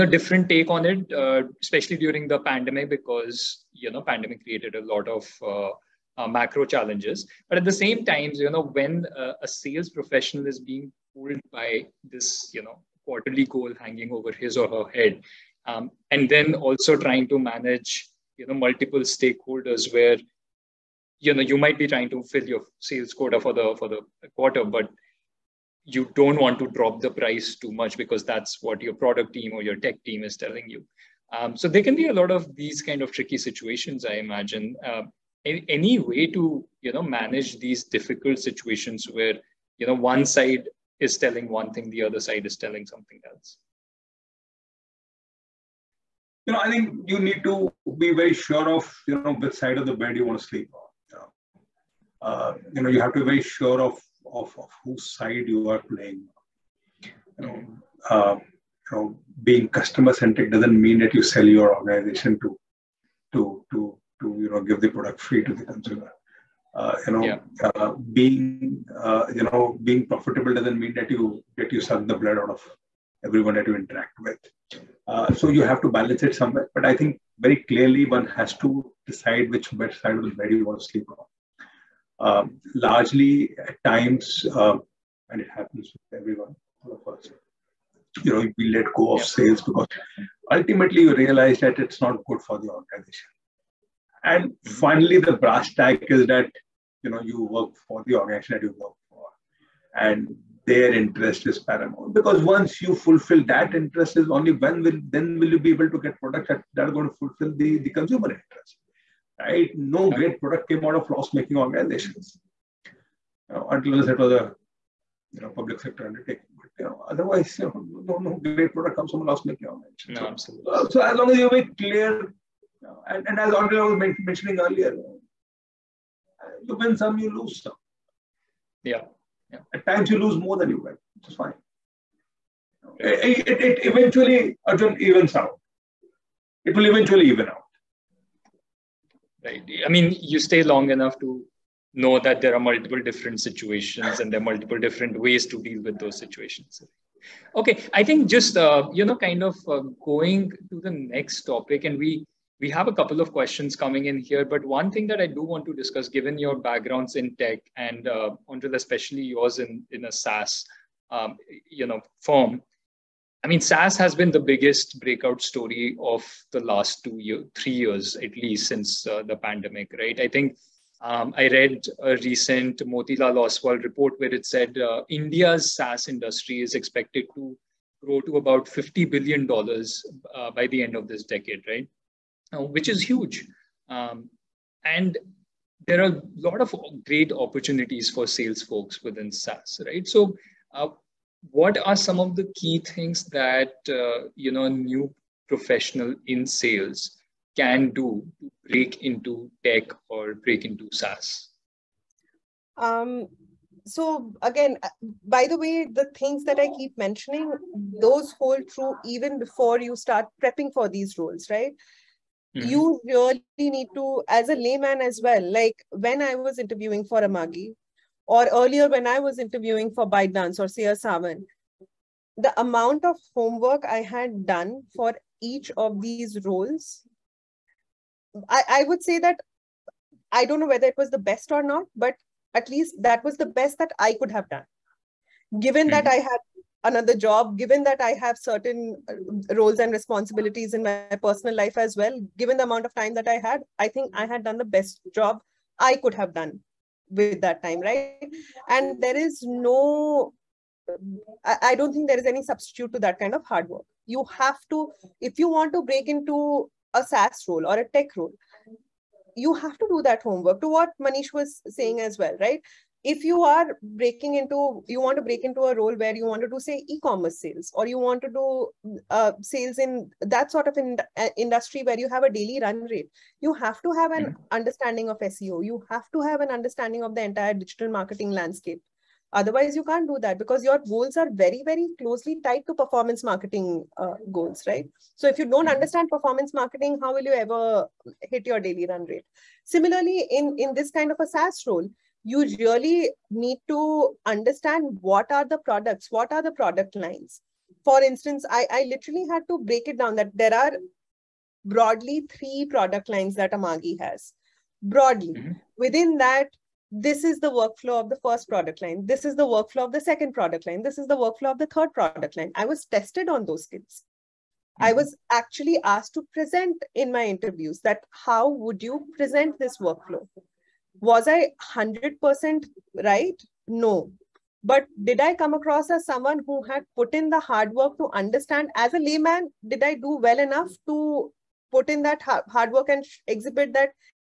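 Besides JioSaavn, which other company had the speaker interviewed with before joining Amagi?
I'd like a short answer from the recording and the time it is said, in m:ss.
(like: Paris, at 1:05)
ByteDance, at 3:40.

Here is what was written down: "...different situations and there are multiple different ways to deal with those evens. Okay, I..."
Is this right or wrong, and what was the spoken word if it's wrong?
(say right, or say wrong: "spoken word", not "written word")
wrong: "situations", not "evens".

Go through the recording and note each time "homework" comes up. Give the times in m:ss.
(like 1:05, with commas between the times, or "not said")
3:43, 4:20.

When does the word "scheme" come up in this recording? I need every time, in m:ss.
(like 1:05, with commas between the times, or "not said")
not said.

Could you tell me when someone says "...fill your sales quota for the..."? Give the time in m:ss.
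0:22.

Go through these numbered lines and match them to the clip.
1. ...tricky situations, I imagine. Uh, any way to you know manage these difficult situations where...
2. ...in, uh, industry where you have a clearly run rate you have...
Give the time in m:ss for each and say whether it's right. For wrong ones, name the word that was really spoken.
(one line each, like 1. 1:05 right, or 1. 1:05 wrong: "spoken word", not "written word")
1. 0:33 right
2. 4:30 wrong: "daily", not "clearly".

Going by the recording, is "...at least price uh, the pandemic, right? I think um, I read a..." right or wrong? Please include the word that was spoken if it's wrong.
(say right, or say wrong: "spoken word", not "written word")
wrong: "since", not "price".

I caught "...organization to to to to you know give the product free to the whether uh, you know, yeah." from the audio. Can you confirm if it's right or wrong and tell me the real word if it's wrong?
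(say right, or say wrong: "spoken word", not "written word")
wrong: "consumer", not "whether".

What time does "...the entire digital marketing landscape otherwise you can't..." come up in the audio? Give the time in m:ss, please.
4:37.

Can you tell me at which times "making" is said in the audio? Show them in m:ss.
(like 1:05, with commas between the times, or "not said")
1:51, 1:59.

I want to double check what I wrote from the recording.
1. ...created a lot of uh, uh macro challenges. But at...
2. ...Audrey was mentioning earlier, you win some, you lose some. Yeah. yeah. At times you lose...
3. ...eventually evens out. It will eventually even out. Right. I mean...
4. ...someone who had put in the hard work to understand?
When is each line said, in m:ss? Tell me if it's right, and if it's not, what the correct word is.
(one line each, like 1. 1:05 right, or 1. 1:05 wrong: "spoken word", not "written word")
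1. 0:04 right
2. 2:03 right
3. 2:13 right
4. 5:26 right.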